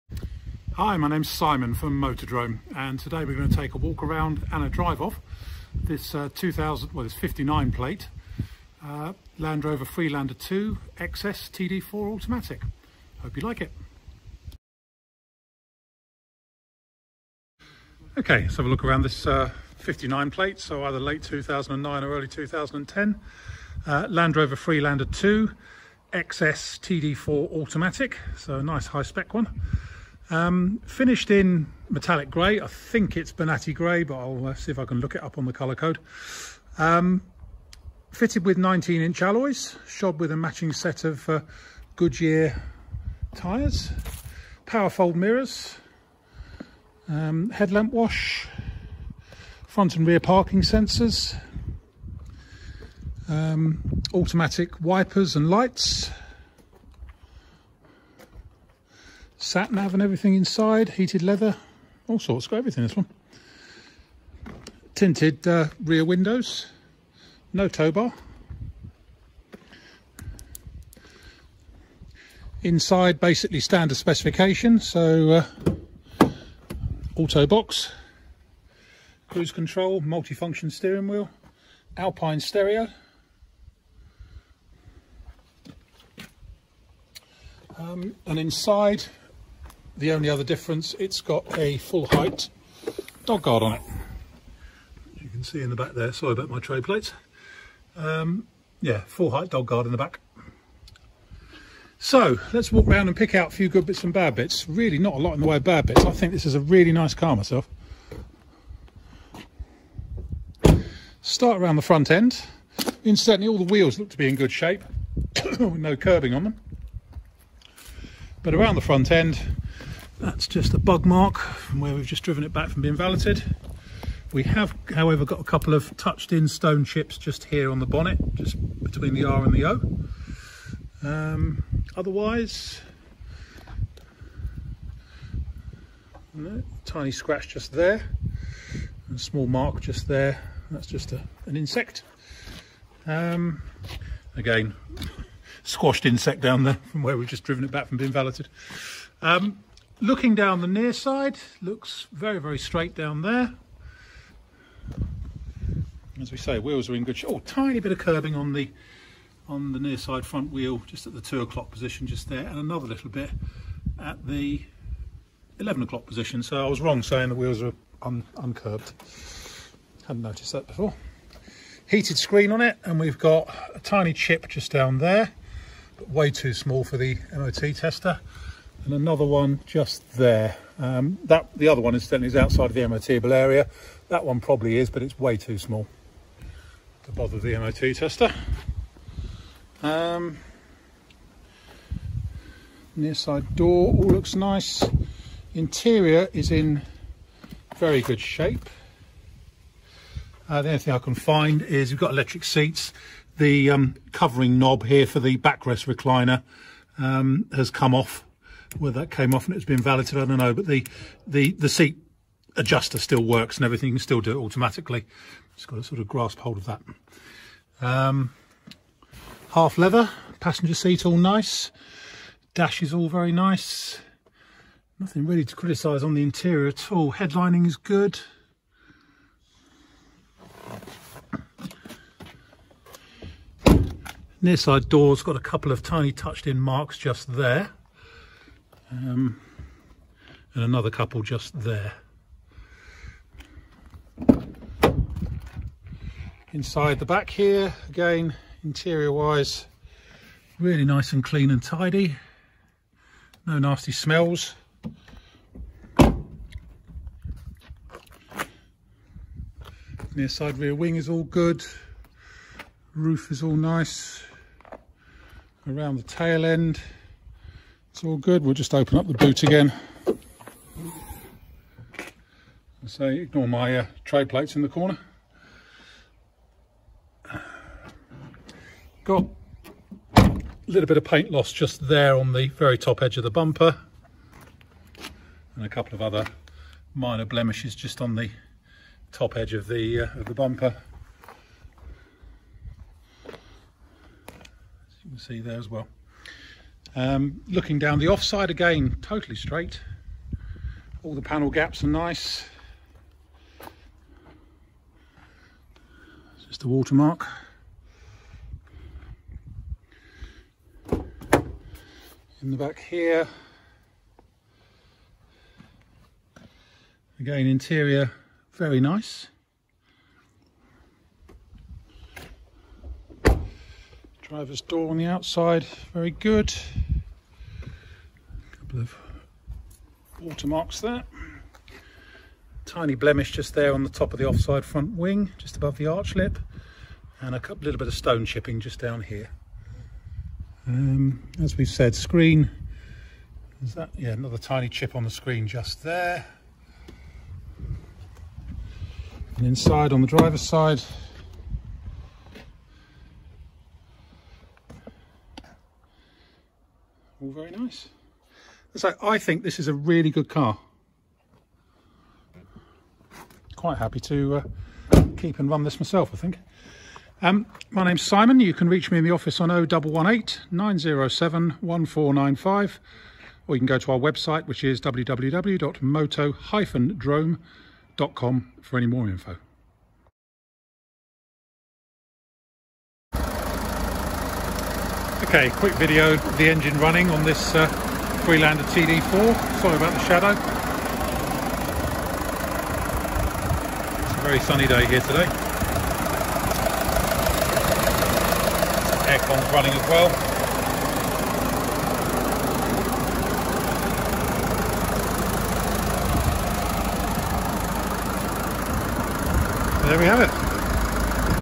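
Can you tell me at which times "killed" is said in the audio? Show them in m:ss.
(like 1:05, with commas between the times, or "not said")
not said.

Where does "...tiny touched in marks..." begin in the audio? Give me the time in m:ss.
3:55.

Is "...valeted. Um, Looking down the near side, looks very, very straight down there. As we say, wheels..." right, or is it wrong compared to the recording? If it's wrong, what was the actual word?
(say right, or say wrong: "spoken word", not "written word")
right.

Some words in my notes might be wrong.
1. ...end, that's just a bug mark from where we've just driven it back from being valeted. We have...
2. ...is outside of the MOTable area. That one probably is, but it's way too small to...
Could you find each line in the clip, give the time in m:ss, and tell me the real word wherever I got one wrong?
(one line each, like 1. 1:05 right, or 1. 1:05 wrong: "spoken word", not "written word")
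1. 1:59 right
2. 3:02 right.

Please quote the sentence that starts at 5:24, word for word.
driver's door on the outside very good couple of watermarks there.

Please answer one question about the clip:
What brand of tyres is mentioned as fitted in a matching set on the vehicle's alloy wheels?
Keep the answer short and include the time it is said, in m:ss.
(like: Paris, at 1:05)
Goodyear, at 0:41.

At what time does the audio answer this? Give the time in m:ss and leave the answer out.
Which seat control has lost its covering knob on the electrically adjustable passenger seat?
3:25.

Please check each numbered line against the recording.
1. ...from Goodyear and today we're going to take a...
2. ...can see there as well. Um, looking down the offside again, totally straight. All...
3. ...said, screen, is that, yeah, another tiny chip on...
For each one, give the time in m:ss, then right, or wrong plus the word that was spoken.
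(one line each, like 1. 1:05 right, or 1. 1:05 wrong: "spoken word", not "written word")
1. 0:01 wrong: "Motodrome", not "Goodyear"
2. 4:55 right
3. 5:41 right.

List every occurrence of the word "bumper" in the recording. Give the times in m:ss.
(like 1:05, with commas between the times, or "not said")
4:43, 4:50.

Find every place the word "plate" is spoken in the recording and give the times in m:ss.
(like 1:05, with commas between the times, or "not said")
0:07, 0:20, 1:36, 4:34.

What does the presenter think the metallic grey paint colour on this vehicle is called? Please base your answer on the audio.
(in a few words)
Bonatti grey.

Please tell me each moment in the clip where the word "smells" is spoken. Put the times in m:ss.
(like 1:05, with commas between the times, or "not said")
4:13.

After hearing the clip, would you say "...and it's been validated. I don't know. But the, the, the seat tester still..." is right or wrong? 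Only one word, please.
wrong.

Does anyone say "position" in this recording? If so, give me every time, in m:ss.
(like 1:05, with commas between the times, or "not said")
2:41, 2:46.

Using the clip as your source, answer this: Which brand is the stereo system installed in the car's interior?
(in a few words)
Alpine.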